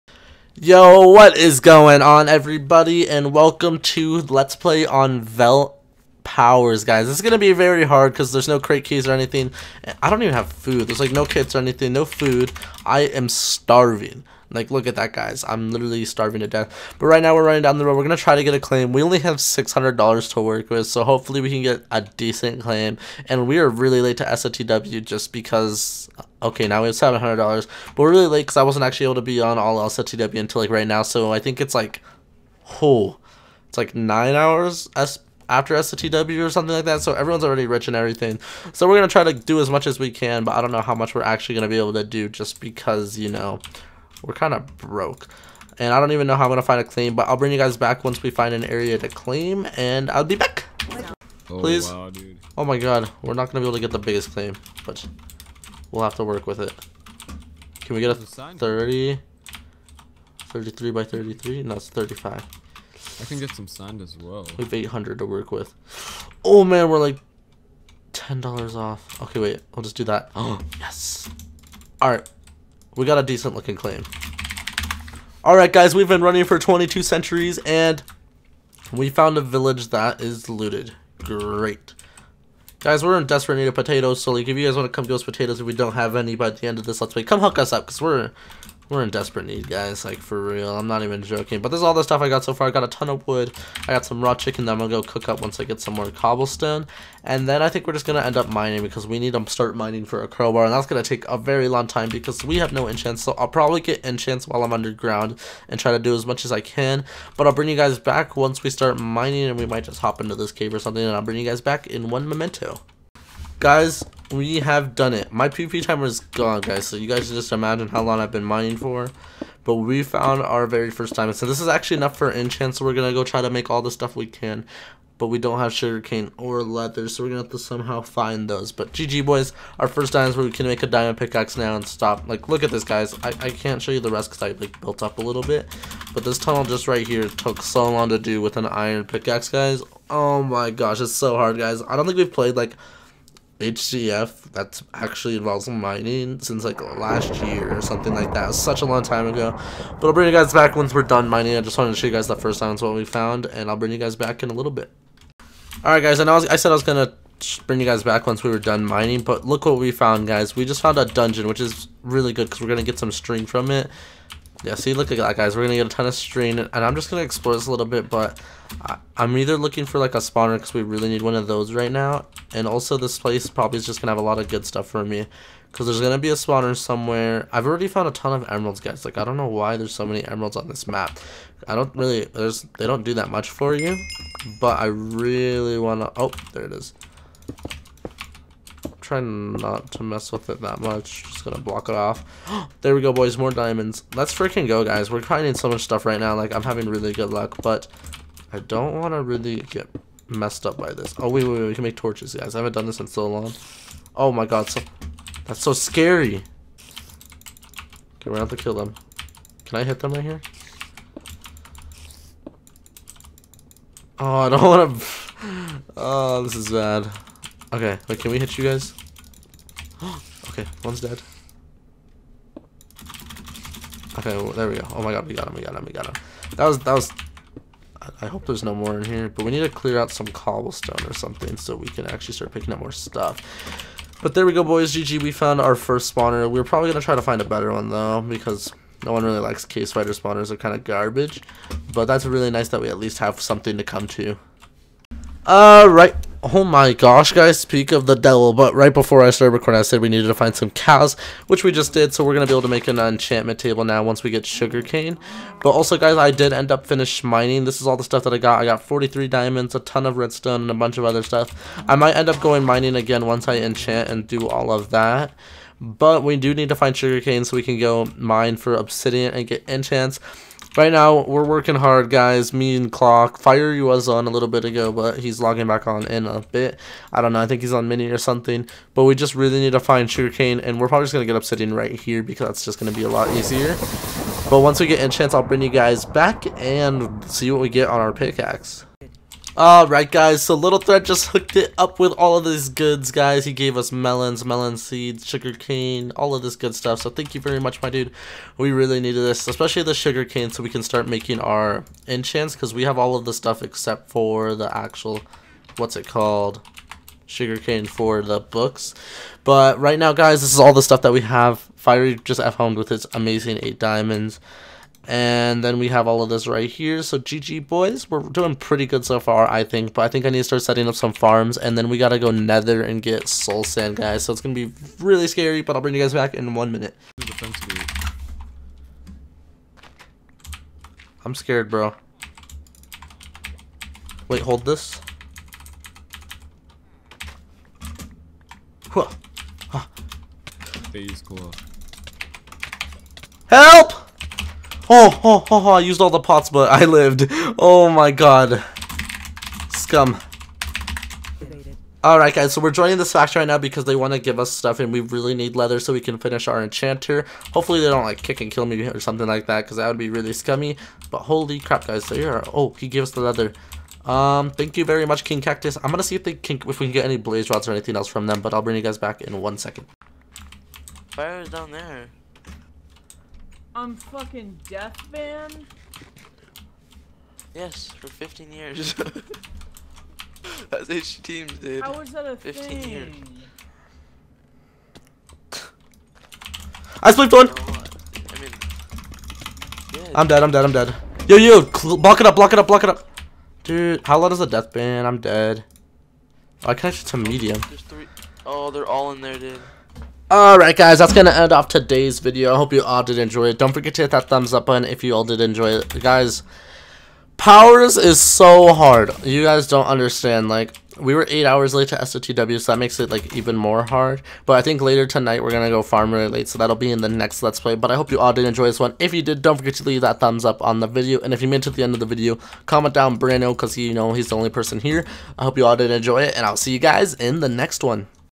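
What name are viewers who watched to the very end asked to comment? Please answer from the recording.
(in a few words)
Brando.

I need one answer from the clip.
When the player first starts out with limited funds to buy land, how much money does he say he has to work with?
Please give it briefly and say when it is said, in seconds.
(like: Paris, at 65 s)
$600, at 19 s.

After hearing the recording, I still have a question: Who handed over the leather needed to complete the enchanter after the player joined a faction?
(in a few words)
King Cactus.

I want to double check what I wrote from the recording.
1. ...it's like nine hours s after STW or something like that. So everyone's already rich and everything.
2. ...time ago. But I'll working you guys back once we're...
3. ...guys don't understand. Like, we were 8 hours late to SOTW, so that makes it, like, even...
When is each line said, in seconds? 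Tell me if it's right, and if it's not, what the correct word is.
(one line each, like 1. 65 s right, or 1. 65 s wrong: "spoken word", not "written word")
1. 33 s right
2. 149 s wrong: "bring", not "working"
3. 409 s right.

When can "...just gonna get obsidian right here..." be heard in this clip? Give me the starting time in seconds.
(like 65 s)
281 s.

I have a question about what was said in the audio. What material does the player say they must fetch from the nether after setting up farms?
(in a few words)
Soul sand.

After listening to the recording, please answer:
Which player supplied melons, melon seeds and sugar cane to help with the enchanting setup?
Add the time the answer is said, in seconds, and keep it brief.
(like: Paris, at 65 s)
Little Thread, at 290 s.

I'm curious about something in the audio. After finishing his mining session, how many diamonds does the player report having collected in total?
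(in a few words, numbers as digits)
43.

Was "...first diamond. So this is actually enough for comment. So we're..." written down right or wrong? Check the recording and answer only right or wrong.
wrong.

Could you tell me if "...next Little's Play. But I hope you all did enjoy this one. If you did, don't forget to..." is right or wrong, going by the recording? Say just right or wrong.
wrong.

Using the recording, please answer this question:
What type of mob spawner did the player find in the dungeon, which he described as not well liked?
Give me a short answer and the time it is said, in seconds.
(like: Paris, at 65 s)
Cave spider, at 239 s.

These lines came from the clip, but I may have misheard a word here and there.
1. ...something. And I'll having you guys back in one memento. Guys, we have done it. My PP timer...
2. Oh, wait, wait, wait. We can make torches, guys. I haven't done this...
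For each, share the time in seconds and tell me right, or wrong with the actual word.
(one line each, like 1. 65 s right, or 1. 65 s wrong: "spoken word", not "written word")
1. 110 s wrong: "bring", not "having"
2. 201 s right.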